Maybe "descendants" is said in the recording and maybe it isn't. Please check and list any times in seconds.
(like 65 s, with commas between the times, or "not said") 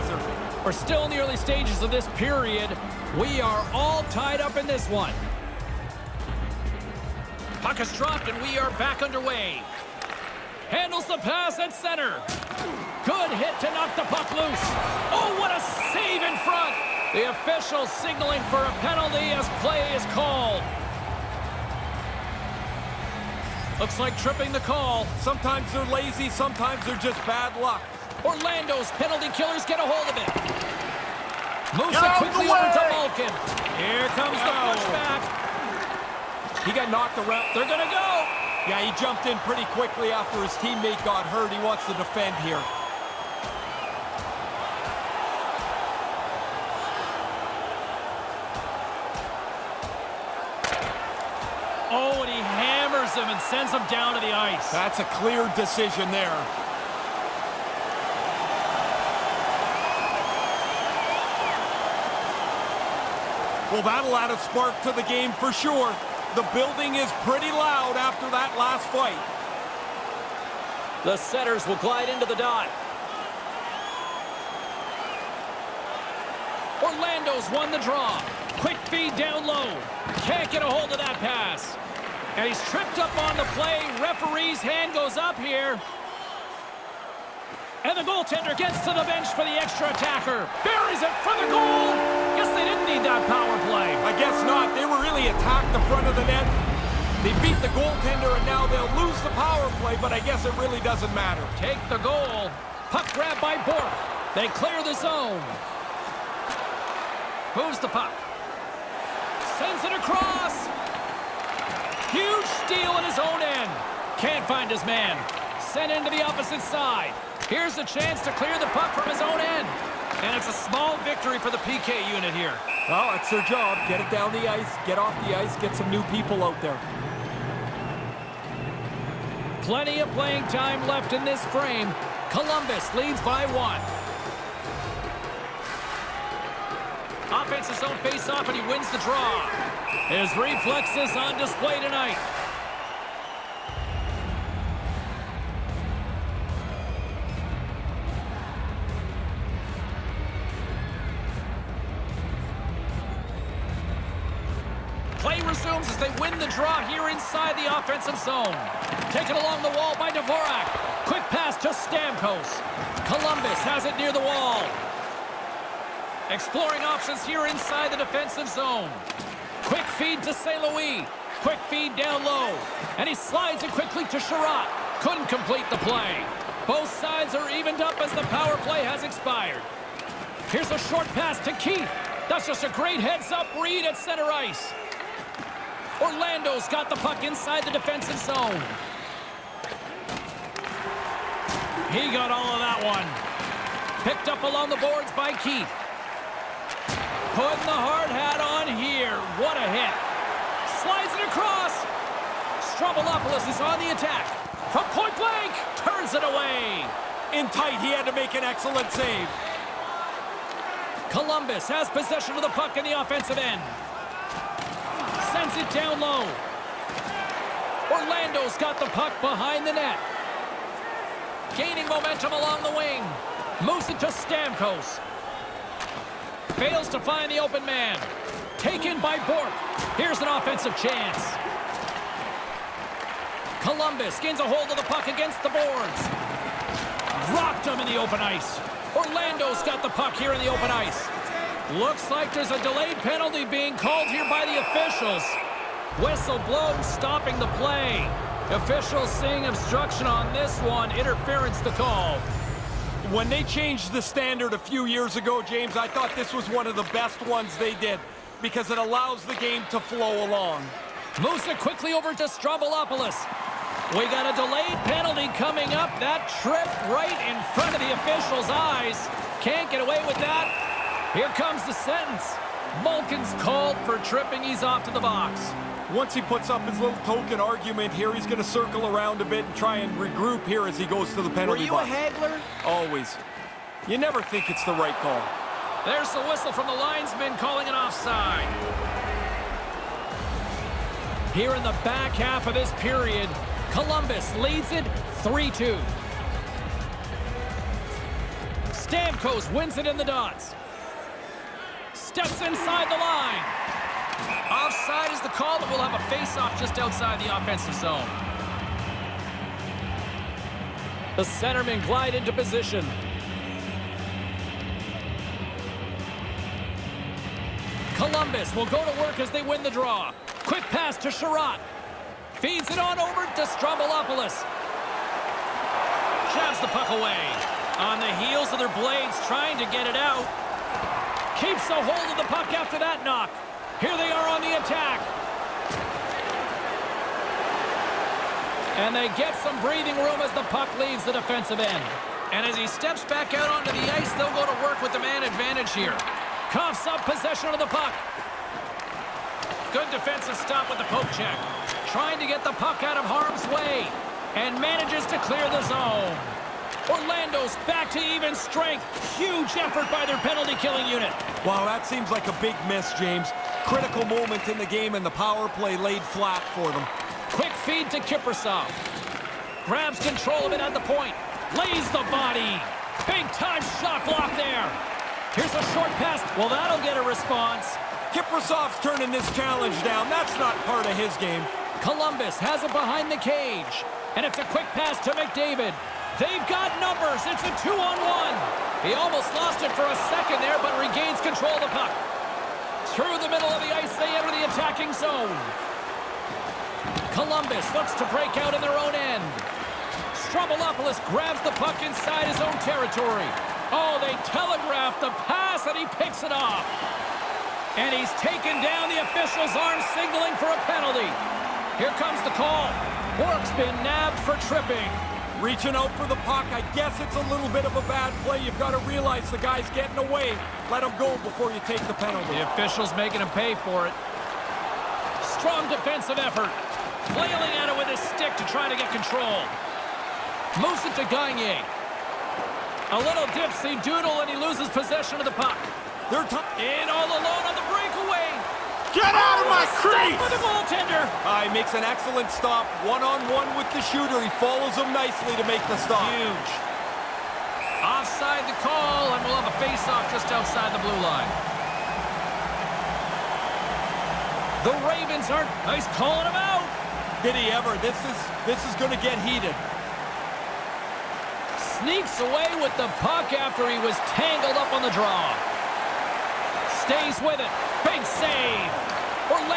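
not said.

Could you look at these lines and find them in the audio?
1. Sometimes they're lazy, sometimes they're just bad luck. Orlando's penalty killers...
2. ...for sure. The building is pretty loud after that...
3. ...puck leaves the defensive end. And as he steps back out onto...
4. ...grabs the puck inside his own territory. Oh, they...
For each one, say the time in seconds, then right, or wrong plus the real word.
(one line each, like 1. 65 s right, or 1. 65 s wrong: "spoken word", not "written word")
1. 25 s right
2. 65 s right
3. 340 s right
4. 401 s right.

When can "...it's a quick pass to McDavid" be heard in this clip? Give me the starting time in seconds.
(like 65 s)
384 s.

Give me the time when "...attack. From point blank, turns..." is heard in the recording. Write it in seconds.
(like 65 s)
203 s.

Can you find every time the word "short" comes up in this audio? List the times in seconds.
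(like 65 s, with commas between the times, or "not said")
180 s, 375 s.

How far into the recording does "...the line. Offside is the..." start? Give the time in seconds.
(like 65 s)
302 s.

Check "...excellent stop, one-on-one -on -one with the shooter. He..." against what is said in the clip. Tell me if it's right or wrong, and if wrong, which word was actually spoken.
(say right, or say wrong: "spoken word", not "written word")
right.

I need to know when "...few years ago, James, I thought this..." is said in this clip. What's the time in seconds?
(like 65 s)
254 s.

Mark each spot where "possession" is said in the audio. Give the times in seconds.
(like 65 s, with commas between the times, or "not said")
211 s, 347 s, 434 s.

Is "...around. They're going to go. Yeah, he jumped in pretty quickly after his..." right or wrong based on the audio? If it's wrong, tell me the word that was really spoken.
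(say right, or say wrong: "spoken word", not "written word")
right.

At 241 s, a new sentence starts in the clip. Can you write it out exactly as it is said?
Looks like there's a delayed penalty being called here by the officials.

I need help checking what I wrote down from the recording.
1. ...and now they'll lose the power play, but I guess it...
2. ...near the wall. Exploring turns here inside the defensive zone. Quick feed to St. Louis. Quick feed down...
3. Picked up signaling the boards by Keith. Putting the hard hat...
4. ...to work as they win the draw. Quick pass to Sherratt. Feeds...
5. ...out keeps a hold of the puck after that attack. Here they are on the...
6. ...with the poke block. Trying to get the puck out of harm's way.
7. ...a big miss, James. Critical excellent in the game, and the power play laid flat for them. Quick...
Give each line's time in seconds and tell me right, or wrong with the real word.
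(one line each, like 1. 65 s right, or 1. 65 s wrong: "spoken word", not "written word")
1. 98 s right
2. 163 s wrong: "options", not "turns"
3. 194 s wrong: "along", not "signaling"
4. 318 s right
5. 329 s wrong: "knock", not "attack"
6. 350 s wrong: "check", not "block"
7. 362 s wrong: "moment", not "excellent".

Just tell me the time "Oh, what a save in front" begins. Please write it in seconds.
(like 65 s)
15 s.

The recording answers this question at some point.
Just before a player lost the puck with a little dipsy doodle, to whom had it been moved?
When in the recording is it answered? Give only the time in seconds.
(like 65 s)
431 s.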